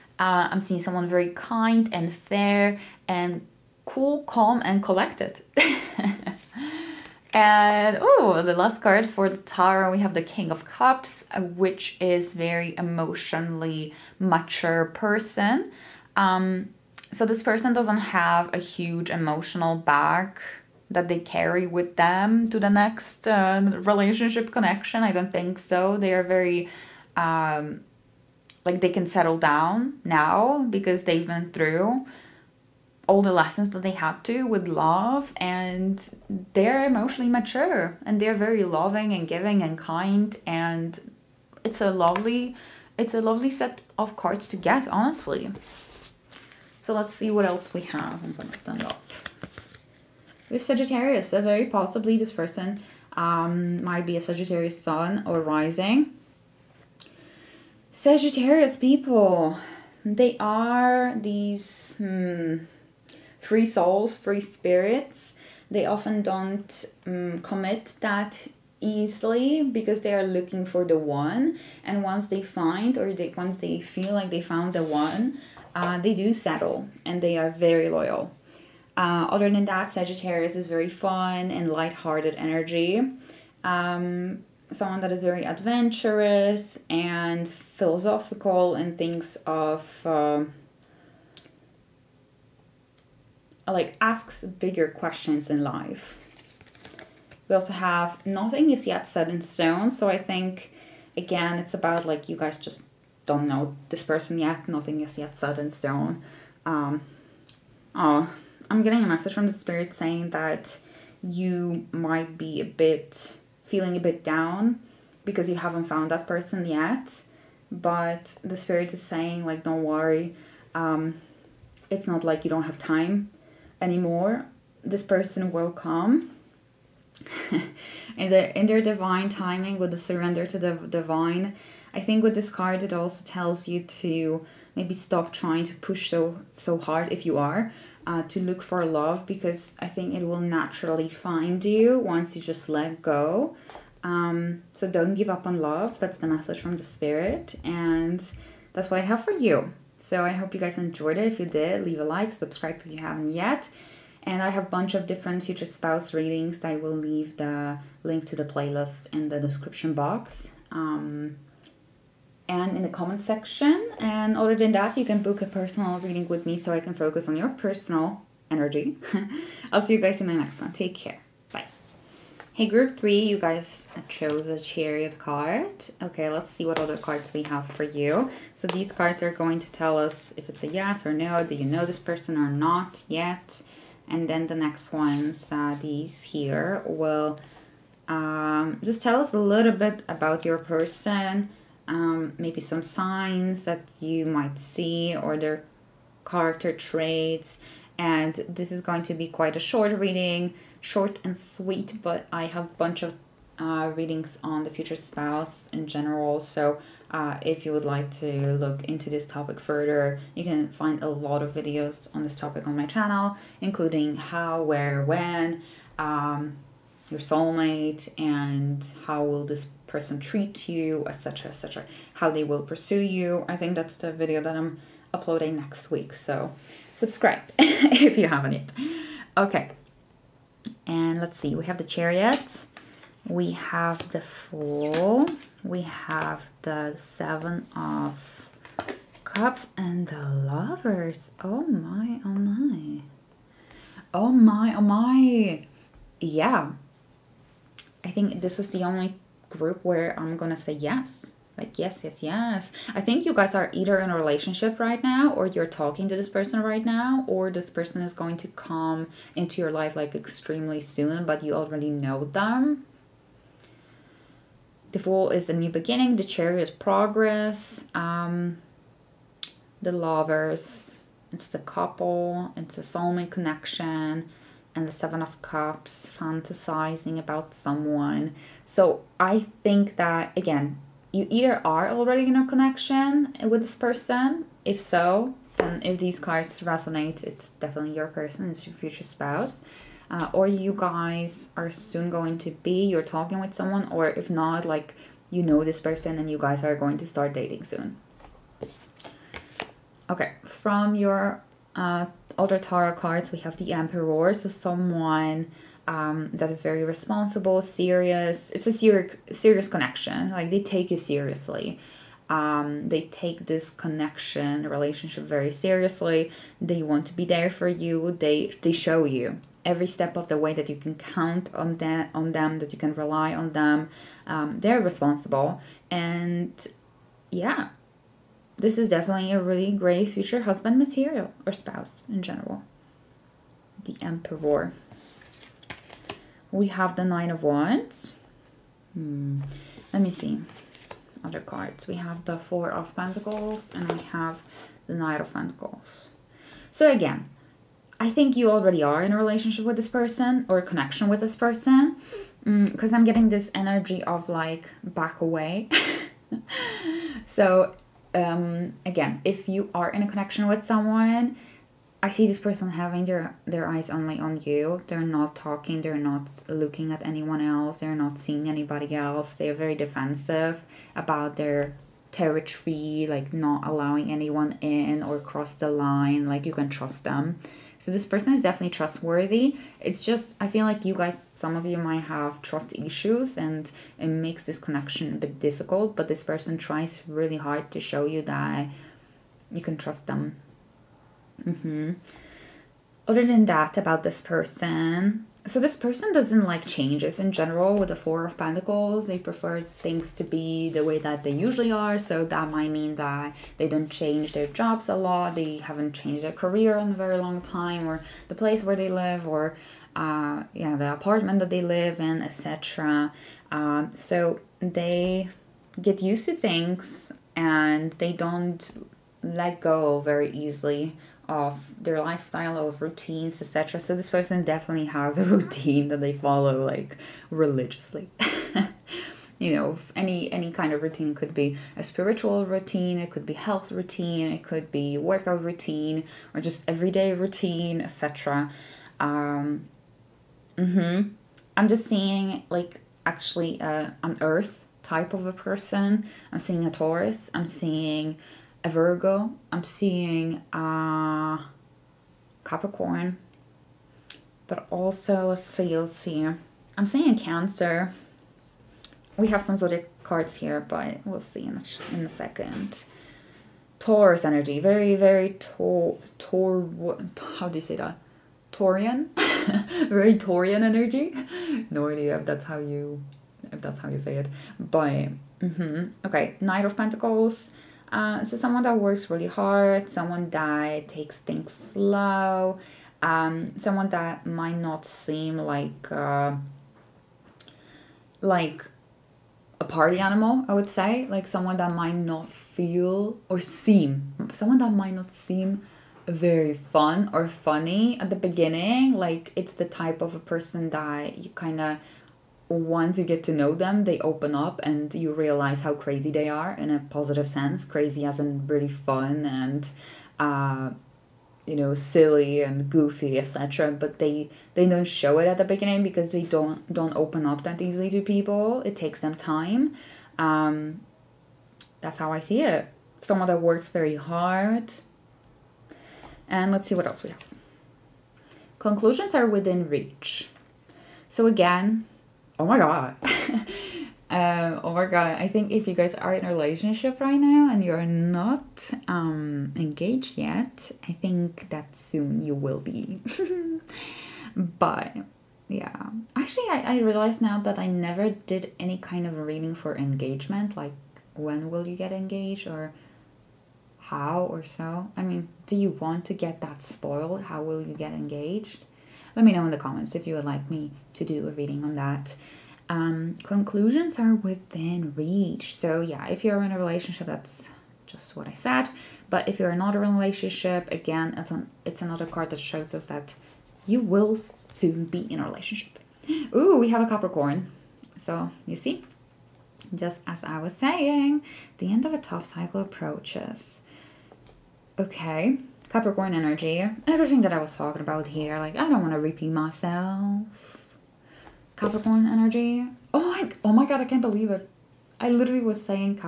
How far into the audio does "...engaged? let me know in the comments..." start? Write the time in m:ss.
9:17.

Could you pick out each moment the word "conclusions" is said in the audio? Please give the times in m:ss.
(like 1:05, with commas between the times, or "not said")
8:48, 9:23.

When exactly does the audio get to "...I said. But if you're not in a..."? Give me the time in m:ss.
9:28.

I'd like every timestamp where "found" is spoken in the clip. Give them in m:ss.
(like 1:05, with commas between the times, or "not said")
1:14, 1:55.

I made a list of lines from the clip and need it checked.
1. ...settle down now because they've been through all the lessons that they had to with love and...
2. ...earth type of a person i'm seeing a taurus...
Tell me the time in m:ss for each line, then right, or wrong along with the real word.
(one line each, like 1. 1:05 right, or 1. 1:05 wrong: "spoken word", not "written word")
1. 0:29 right
2. 7:24 right.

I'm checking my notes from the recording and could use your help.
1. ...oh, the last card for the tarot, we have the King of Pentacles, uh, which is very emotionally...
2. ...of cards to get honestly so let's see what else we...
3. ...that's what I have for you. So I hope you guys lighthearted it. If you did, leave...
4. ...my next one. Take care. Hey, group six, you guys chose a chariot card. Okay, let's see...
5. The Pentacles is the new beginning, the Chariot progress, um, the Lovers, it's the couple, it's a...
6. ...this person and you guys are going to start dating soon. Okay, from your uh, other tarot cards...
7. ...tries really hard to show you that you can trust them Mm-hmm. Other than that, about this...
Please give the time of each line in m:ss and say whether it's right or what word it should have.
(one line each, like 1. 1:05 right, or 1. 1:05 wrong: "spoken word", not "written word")
1. 0:07 wrong: "Cups", not "Pentacles"
2. 0:43 right
3. 2:28 wrong: "enjoyed", not "lighthearted"
4. 2:50 wrong: "three", not "six"
5. 4:24 wrong: "Fool", not "Pentacles"
6. 4:55 right
7. 6:26 right.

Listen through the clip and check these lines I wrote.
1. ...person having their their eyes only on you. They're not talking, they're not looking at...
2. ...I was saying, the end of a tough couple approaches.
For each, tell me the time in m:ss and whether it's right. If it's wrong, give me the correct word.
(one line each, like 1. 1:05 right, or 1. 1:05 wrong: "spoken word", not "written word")
1. 6:02 right
2. 9:40 wrong: "cycle", not "couple".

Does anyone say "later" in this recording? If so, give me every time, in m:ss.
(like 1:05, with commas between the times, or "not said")
not said.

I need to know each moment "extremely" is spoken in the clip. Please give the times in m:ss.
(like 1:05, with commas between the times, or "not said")
4:20.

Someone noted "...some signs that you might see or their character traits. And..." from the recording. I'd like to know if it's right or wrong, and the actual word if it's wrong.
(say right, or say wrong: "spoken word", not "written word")
right.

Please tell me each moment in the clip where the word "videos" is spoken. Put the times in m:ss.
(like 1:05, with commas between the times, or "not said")
3:31, 3:44.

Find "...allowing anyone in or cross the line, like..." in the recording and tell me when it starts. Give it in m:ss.
6:13.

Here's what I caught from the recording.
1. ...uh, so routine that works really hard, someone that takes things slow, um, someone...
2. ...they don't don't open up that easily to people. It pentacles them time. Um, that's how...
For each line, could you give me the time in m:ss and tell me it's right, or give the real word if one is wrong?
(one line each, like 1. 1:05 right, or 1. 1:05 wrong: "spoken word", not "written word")
1. 7:57 wrong: "someone", not "routine"
2. 8:36 wrong: "takes", not "pentacles".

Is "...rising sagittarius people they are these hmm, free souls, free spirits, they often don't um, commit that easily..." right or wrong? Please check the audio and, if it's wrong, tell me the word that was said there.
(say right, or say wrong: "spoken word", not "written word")
right.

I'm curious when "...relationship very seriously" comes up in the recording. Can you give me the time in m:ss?
5:14.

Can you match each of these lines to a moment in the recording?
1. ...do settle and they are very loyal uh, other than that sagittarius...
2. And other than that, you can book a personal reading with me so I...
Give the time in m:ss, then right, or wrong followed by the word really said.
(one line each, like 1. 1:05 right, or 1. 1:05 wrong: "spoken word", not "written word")
1. 1:16 right
2. 2:43 right.